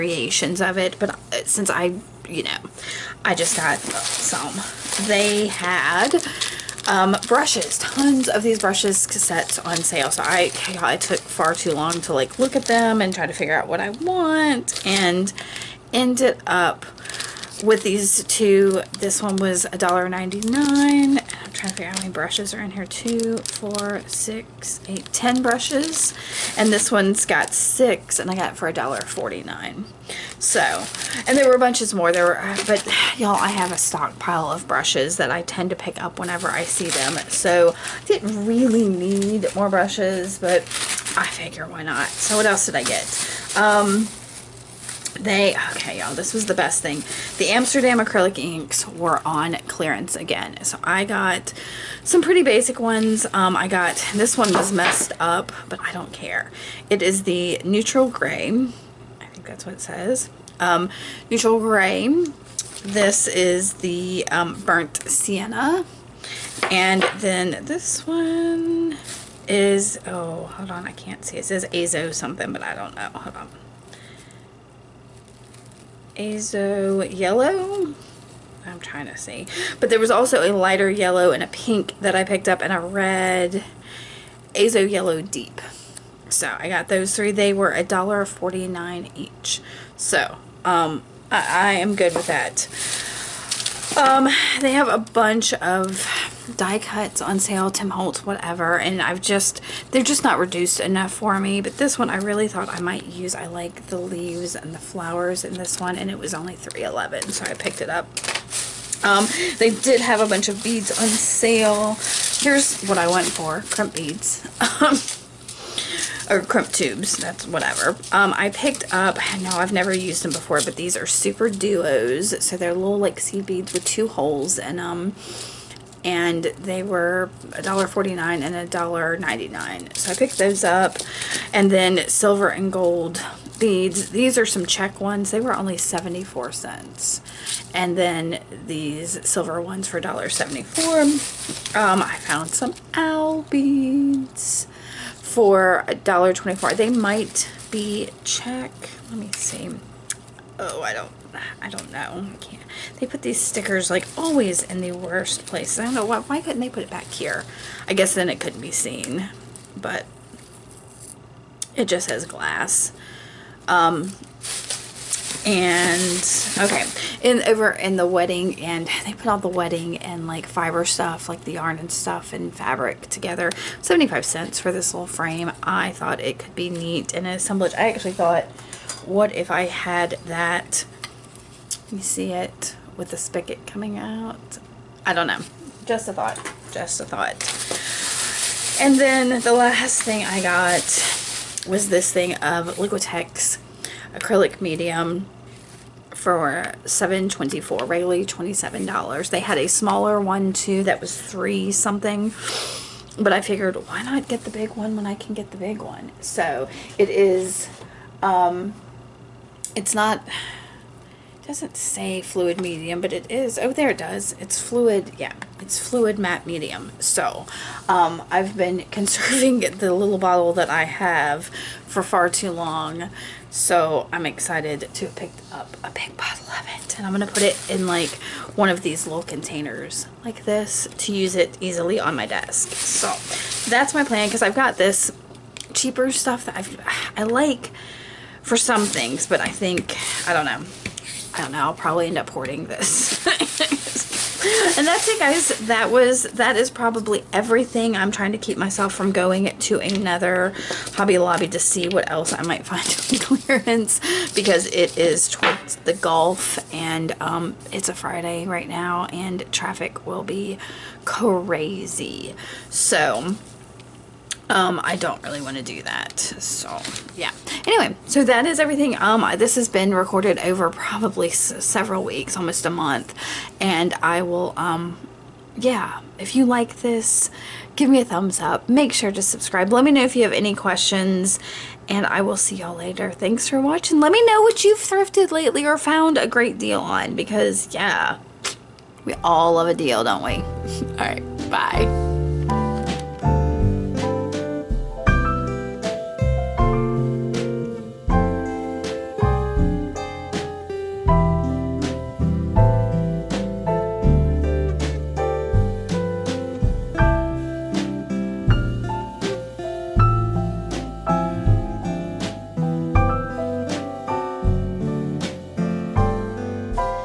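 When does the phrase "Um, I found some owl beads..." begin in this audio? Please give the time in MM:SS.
02:21.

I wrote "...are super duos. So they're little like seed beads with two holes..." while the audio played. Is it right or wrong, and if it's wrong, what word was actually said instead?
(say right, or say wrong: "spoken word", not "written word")
right.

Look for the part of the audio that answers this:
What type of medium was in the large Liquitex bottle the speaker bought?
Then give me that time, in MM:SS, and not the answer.
03:35.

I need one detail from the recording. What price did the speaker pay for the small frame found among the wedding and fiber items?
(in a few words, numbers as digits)
75 cents.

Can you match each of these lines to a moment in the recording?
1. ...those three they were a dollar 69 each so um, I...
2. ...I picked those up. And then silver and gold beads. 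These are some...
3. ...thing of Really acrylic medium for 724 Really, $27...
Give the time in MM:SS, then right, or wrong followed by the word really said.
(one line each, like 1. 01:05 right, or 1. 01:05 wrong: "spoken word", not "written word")
1. 01:26 wrong: "49", not "69"
2. 02:10 right
3. 03:12 wrong: "Liquitex", not "Really".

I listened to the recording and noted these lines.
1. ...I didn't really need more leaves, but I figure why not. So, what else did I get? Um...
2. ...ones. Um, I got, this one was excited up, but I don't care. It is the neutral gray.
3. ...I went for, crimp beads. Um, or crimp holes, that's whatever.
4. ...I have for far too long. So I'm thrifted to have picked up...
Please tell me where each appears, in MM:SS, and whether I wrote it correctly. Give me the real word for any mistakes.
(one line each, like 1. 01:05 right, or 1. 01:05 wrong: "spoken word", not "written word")
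1. 00:38 wrong: "brushes", not "leaves"
2. 00:52 wrong: "messed", not "excited"
3. 01:52 wrong: "tubes", not "holes"
4. 03:40 wrong: "excited", not "thrifted".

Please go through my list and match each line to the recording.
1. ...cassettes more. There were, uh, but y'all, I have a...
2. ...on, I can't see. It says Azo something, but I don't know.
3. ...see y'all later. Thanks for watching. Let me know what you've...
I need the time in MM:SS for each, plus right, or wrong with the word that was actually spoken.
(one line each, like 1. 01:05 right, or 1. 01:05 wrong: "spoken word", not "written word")
1. 00:31 wrong: "bunches", not "cassettes"
2. 01:10 right
3. 04:42 right.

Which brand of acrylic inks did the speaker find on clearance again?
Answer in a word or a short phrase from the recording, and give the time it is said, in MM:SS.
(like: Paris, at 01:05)
Amsterdam, at 00:47.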